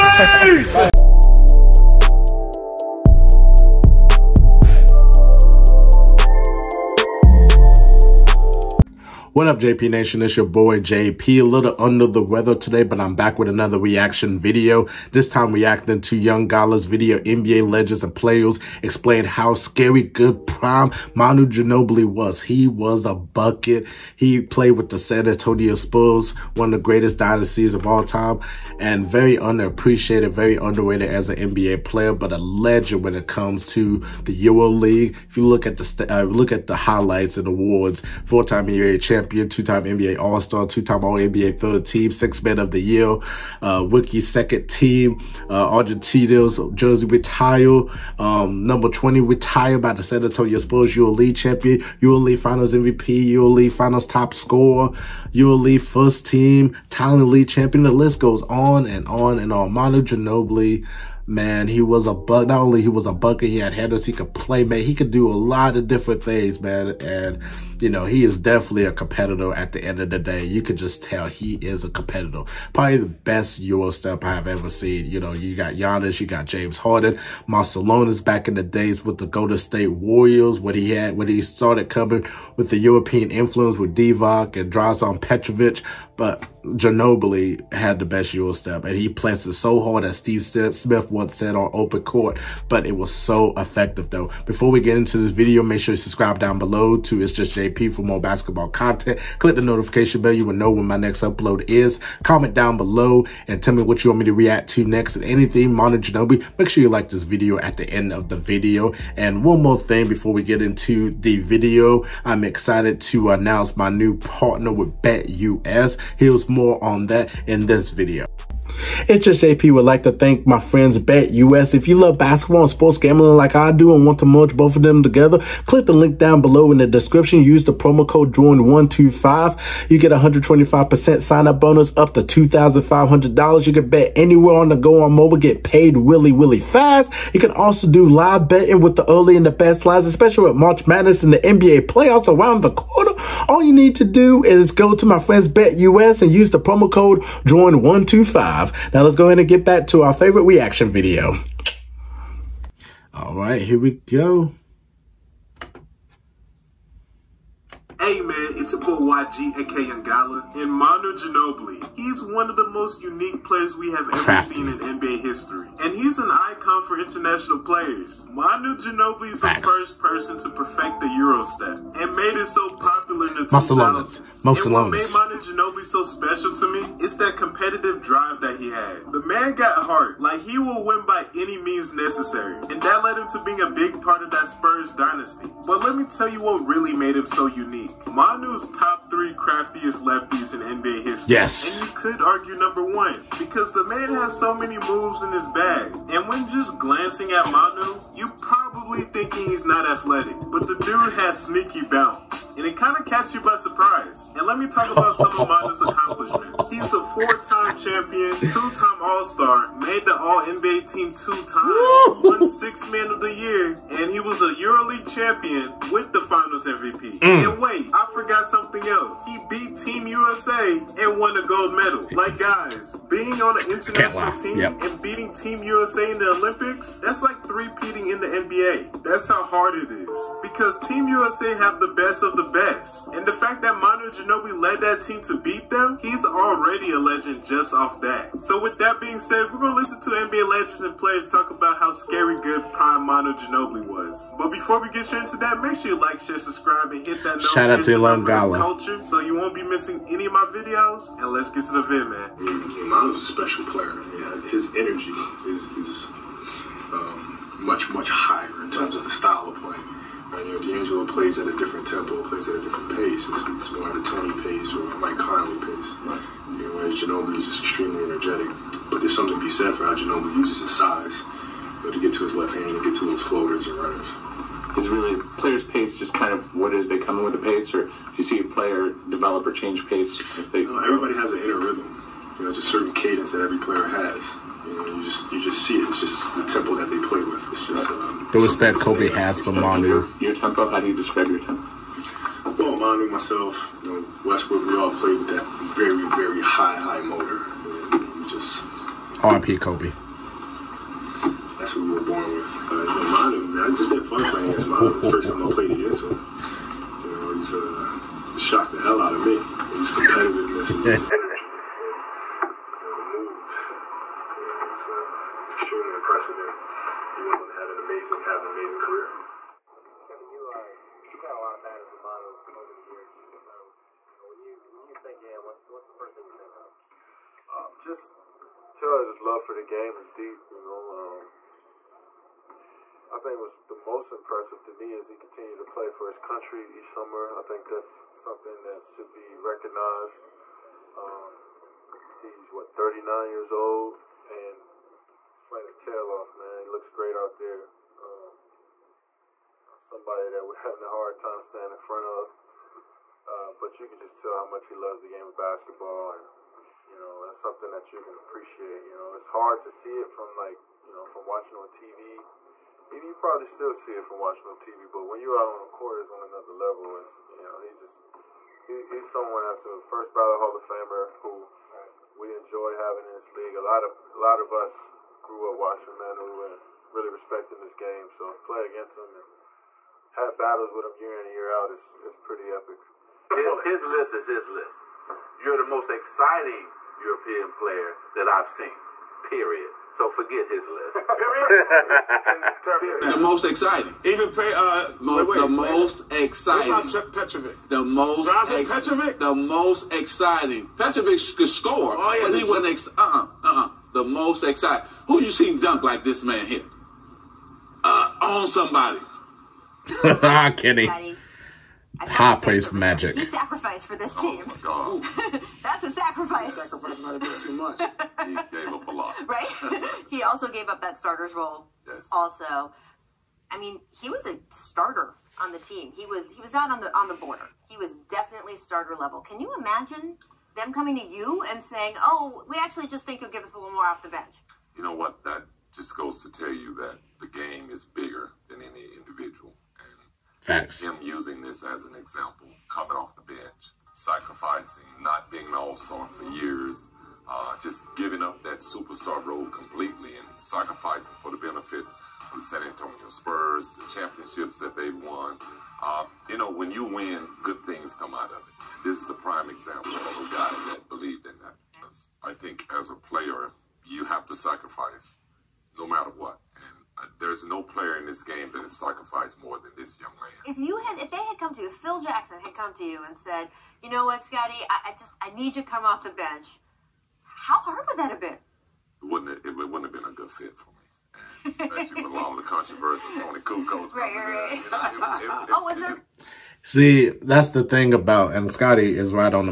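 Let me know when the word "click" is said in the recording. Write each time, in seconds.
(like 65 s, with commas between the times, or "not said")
99 s, 125 s.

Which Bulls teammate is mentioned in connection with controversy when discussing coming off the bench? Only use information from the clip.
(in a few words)
Toni Kukoc.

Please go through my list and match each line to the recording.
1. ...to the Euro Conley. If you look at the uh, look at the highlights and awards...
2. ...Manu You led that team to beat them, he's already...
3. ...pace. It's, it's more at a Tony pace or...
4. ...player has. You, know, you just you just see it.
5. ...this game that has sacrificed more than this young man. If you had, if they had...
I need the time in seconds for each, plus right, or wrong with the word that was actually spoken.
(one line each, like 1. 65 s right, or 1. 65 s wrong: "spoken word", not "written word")
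1. 33 s wrong: "League", not "Conley"
2. 233 s wrong: "Ginobili", not "You"
3. 262 s right
4. 283 s right
5. 468 s right.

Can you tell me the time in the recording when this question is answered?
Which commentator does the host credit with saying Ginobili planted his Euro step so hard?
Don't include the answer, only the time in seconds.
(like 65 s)
90 s.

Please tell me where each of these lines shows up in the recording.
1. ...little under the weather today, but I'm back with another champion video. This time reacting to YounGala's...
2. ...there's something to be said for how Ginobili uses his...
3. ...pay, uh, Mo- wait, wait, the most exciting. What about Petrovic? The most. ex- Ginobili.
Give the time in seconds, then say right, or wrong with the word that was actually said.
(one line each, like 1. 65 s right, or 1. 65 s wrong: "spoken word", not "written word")
1. 11 s wrong: "reaction", not "champion"
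2. 268 s right
3. 394 s wrong: "Petrovic", not "Ginobili".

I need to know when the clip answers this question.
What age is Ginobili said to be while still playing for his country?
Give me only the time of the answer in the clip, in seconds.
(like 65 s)
342 s.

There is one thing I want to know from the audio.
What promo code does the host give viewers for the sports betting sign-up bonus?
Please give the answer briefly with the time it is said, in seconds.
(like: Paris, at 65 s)
JOIN 125, at 128 s.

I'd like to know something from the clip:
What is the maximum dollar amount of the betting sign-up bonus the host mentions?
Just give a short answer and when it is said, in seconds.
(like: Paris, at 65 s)
$2,500, at 132 s.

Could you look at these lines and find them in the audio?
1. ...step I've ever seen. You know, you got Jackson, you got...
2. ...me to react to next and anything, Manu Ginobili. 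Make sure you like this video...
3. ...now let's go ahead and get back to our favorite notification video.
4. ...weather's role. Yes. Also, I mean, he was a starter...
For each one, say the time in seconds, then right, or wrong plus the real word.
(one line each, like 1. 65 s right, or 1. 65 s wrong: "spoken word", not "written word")
1. 73 s wrong: "Giannis", not "Jackson"
2. 104 s right
3. 148 s wrong: "reaction", not "notification"
4. 420 s wrong: "starter", not "weather".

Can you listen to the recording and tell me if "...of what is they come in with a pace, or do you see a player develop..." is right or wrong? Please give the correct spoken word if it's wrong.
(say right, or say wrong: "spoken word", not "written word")
right.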